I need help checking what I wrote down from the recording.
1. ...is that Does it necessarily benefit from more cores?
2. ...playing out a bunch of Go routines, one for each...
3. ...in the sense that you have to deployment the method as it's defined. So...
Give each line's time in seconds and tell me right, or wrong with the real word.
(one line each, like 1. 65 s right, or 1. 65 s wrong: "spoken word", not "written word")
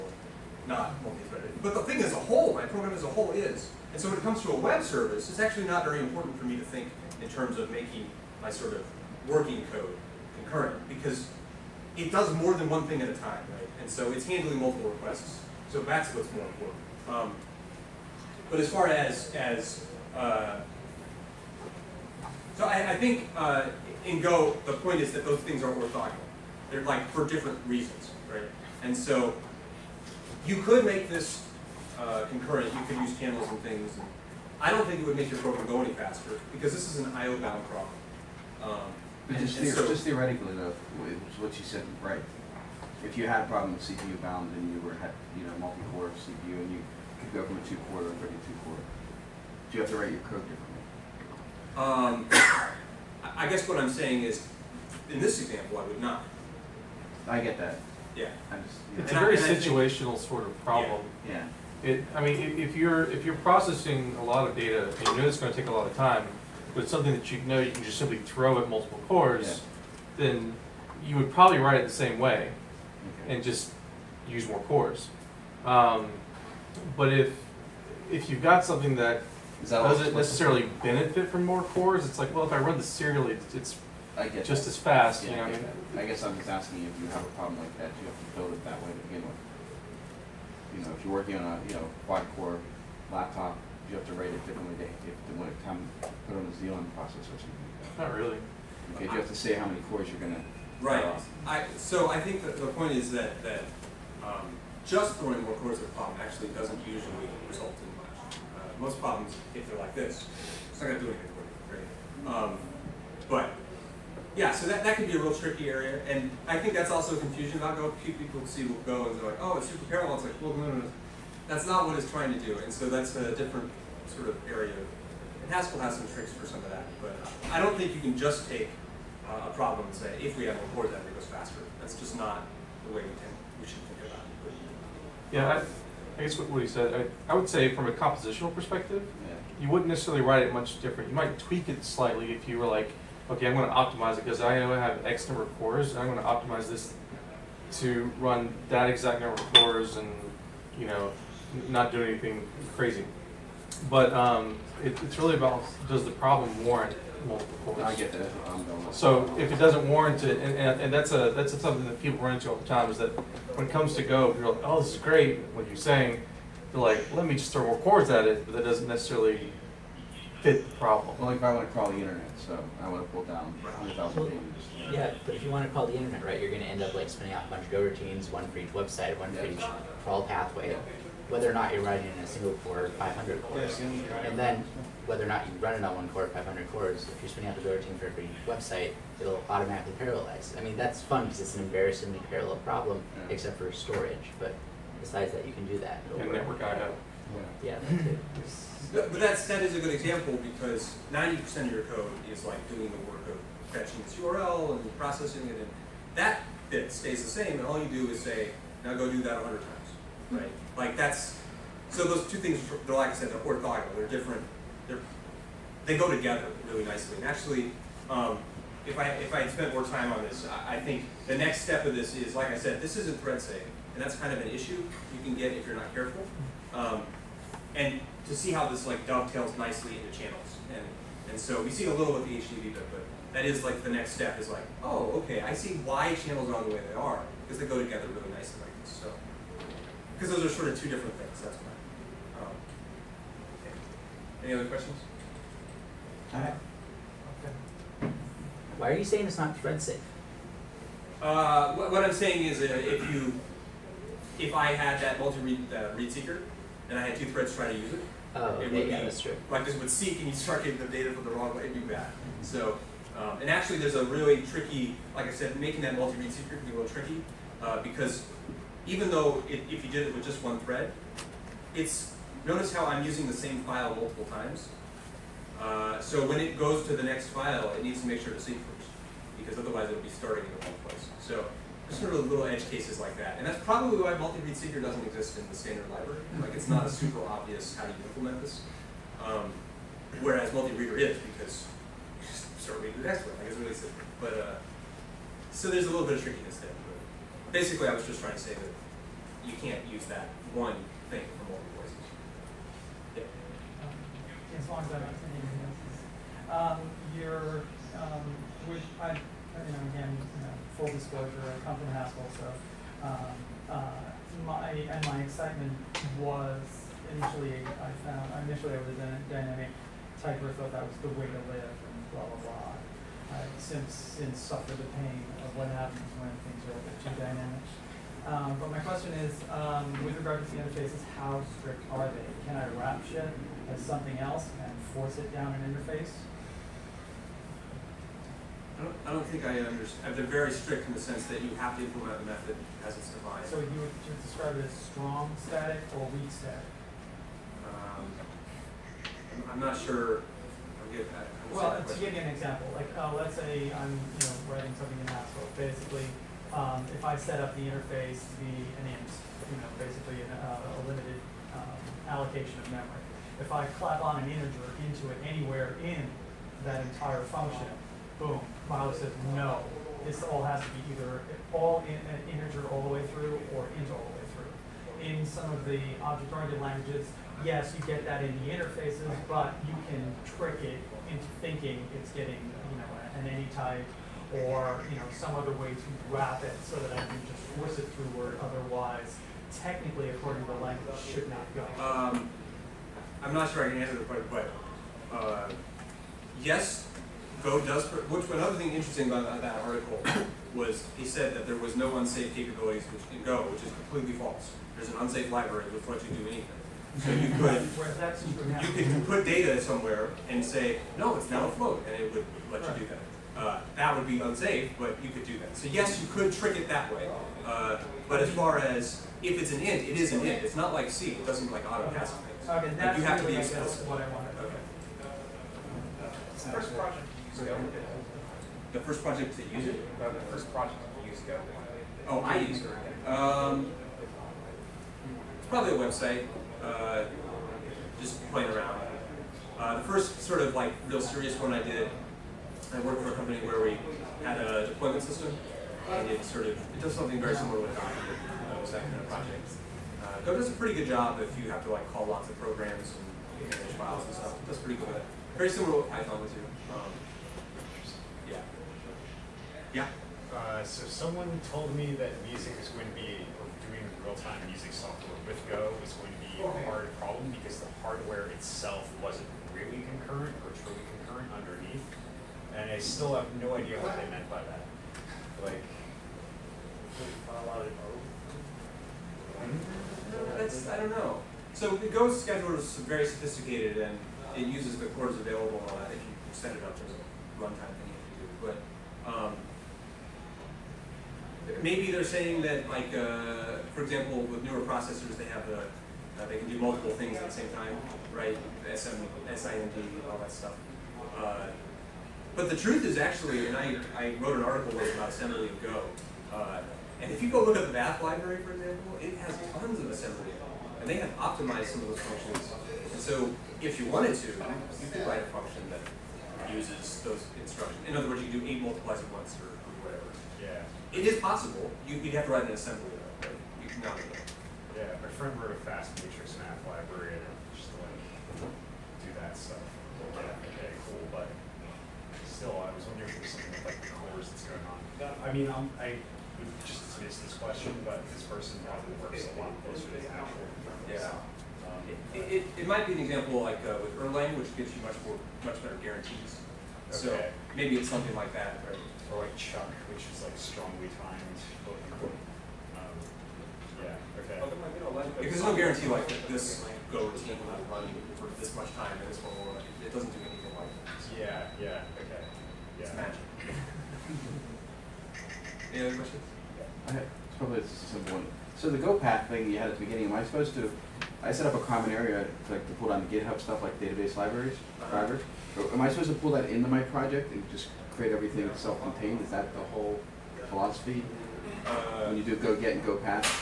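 1. 79 s right
2. 177 s wrong: "spinning", not "playing"
3. 340 s wrong: "implement", not "deployment".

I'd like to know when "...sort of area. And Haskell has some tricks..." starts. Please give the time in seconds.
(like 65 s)
124 s.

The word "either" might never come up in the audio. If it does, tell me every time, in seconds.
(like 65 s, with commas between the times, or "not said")
370 s.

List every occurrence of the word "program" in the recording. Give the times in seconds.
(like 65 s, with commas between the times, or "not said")
2 s, 35 s, 452 s.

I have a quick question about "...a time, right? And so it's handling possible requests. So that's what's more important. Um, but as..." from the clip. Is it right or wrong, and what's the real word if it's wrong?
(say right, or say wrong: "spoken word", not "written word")
wrong: "multiple", not "possible".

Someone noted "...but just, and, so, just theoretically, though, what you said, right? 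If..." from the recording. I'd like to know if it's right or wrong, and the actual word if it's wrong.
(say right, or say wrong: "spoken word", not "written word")
right.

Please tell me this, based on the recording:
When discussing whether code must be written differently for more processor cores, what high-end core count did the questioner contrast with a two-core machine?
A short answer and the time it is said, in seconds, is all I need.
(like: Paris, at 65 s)
32, at 48 s.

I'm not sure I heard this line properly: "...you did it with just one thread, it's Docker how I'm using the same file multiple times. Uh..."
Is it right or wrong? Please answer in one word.
wrong.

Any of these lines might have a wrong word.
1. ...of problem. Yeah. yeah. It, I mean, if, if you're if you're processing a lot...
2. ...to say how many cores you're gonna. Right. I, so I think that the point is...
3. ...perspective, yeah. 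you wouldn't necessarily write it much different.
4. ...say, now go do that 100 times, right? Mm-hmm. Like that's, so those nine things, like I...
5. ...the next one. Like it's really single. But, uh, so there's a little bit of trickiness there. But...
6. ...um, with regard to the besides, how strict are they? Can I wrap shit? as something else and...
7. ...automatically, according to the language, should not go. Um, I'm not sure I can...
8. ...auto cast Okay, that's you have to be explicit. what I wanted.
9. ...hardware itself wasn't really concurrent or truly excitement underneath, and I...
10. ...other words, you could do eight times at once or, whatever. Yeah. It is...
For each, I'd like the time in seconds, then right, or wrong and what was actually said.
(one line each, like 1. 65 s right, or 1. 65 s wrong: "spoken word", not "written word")
1. 60 s right
2. 99 s right
3. 138 s right
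4. 208 s wrong: "two", not "nine"
5. 293 s wrong: "simple", not "single"
6. 329 s wrong: "interfaces", not "besides"
7. 389 s wrong: "technically", not "automatically"
8. 421 s right
9. 467 s wrong: "concurrent", not "excitement"
10. 517 s wrong: "multiplies", not "times".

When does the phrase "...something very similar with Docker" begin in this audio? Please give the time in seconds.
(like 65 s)
446 s.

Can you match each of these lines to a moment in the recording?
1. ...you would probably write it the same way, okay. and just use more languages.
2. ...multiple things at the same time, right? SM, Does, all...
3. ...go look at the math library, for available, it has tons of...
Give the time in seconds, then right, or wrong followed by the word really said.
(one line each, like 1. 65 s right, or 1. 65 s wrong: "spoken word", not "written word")
1. 71 s wrong: "cores", not "languages"
2. 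496 s wrong: "SIMD", not "Does"
3. 507 s wrong: "example", not "available".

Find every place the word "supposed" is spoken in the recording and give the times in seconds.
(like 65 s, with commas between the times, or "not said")
570 s, 575 s.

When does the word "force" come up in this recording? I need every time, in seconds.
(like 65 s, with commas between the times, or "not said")
334 s, 387 s.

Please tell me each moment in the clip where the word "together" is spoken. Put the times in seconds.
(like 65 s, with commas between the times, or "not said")
216 s, 237 s.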